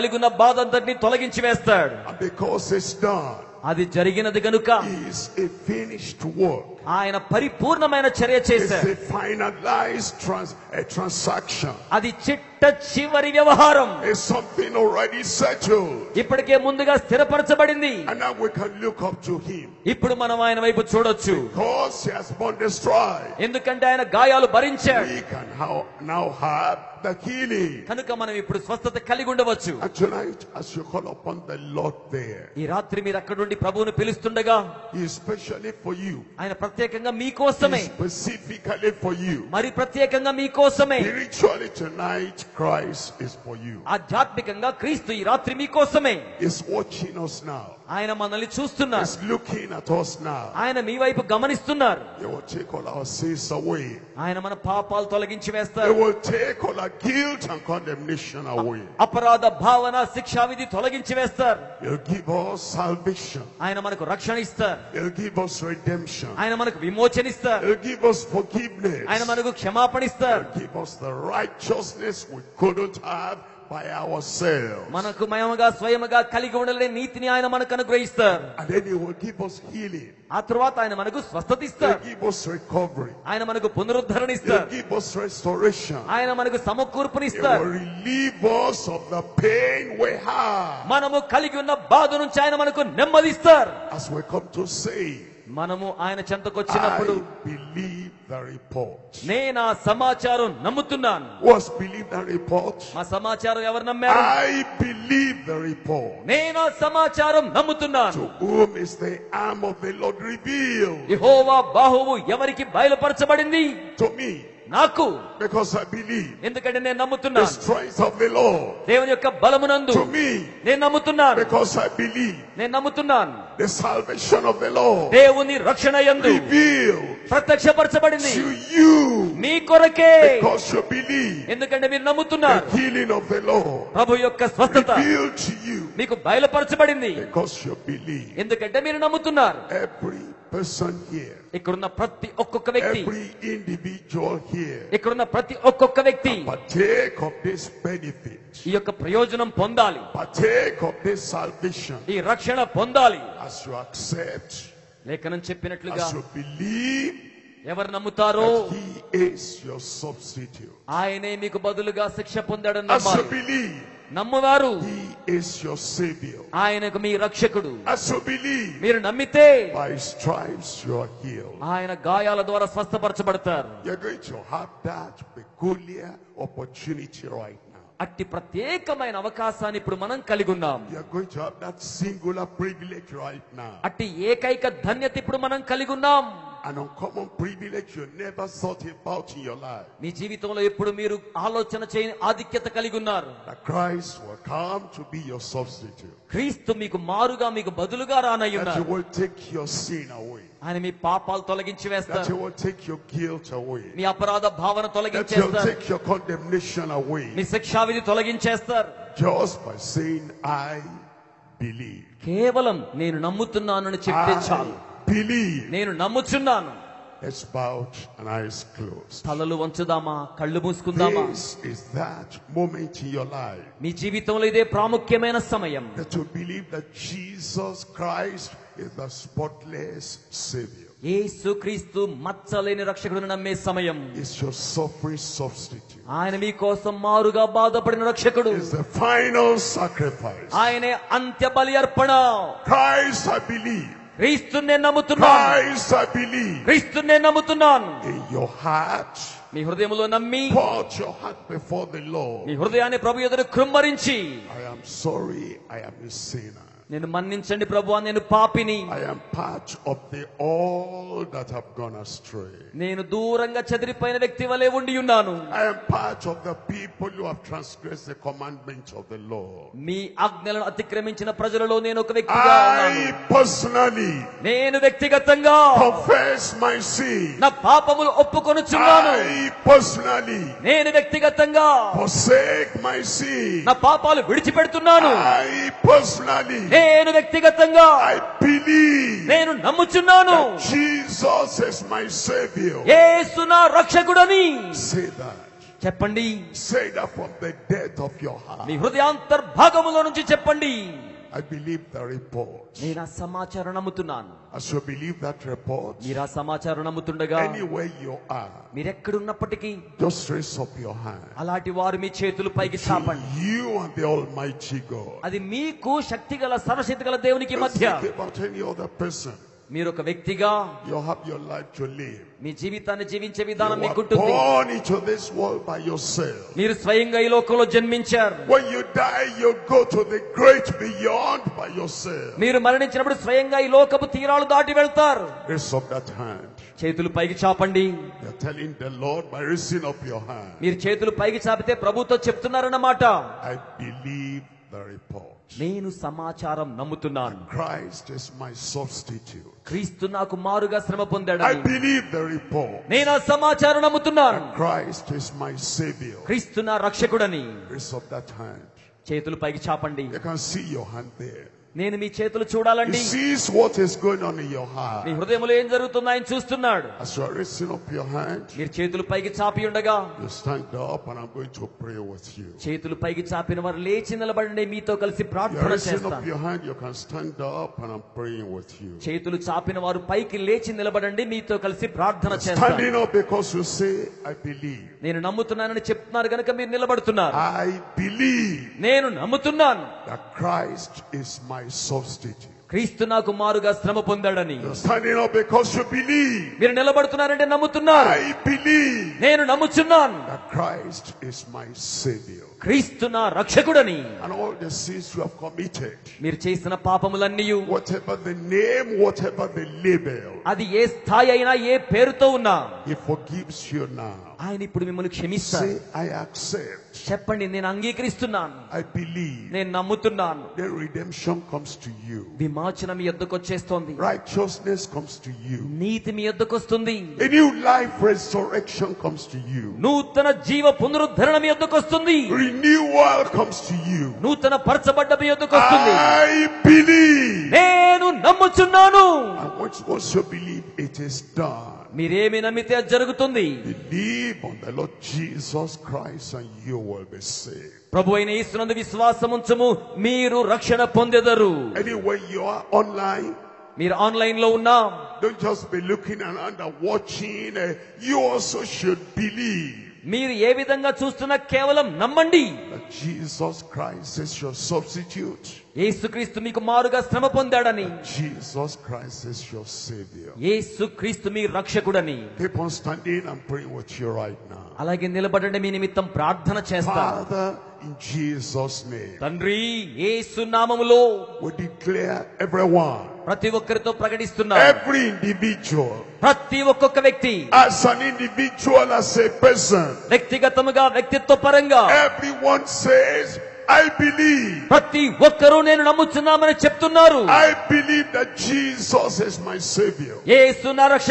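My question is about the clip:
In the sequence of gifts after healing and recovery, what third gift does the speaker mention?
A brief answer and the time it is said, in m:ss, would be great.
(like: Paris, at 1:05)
restoration, at 1:24.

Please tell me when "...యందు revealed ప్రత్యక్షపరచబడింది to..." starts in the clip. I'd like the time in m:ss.
2:06.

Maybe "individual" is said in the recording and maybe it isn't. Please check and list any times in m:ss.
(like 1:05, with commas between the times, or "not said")
2:23, 8:08.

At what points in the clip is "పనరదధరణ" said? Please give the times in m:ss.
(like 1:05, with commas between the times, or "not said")
1:23, 7:10.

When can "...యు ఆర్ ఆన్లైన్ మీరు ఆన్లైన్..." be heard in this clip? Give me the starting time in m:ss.
7:32.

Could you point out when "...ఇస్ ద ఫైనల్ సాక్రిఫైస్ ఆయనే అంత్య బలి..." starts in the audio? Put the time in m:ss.
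3:58.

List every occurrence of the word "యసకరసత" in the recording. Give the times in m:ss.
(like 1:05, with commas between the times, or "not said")
7:45, 7:50.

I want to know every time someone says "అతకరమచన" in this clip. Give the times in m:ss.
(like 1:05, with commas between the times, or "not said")
4:30.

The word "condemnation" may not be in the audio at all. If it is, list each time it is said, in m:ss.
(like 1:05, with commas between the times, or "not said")
0:57, 3:26.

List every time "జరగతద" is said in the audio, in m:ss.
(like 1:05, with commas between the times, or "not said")
6:05, 7:22.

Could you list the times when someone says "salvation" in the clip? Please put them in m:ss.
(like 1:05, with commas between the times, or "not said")
1:02, 2:03, 2:31.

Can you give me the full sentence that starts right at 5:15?
అది మీకు శక్తి గల సర్వశక్తి గల దేవునికి మధ్య Just think about any other person.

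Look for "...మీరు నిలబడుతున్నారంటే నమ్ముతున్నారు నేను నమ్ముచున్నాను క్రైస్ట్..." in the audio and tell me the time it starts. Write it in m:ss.
6:36.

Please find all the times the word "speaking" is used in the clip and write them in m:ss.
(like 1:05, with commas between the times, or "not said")
not said.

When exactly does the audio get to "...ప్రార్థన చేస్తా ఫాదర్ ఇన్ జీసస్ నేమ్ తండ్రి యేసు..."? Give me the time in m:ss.
7:56.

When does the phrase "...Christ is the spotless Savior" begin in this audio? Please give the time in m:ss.
3:47.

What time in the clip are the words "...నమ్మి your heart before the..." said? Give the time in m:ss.
4:10.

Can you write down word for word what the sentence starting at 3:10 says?
మీ జీవితంలో ఎప్పుడు మీరు ఆలోచన చేయని ఆధిక్యత కలిగి ఉన్నారు.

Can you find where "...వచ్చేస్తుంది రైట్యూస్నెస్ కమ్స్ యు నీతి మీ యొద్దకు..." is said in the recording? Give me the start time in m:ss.
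7:03.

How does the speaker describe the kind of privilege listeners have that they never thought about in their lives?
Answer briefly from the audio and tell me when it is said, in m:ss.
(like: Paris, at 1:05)
uncommon, at 3:06.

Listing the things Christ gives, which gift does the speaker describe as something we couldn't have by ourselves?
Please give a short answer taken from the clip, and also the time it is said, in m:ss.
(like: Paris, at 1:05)
righteousness, at 1:11.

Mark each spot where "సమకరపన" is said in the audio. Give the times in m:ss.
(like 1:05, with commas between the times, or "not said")
1:26.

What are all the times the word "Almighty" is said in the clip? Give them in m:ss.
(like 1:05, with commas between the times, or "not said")
5:14.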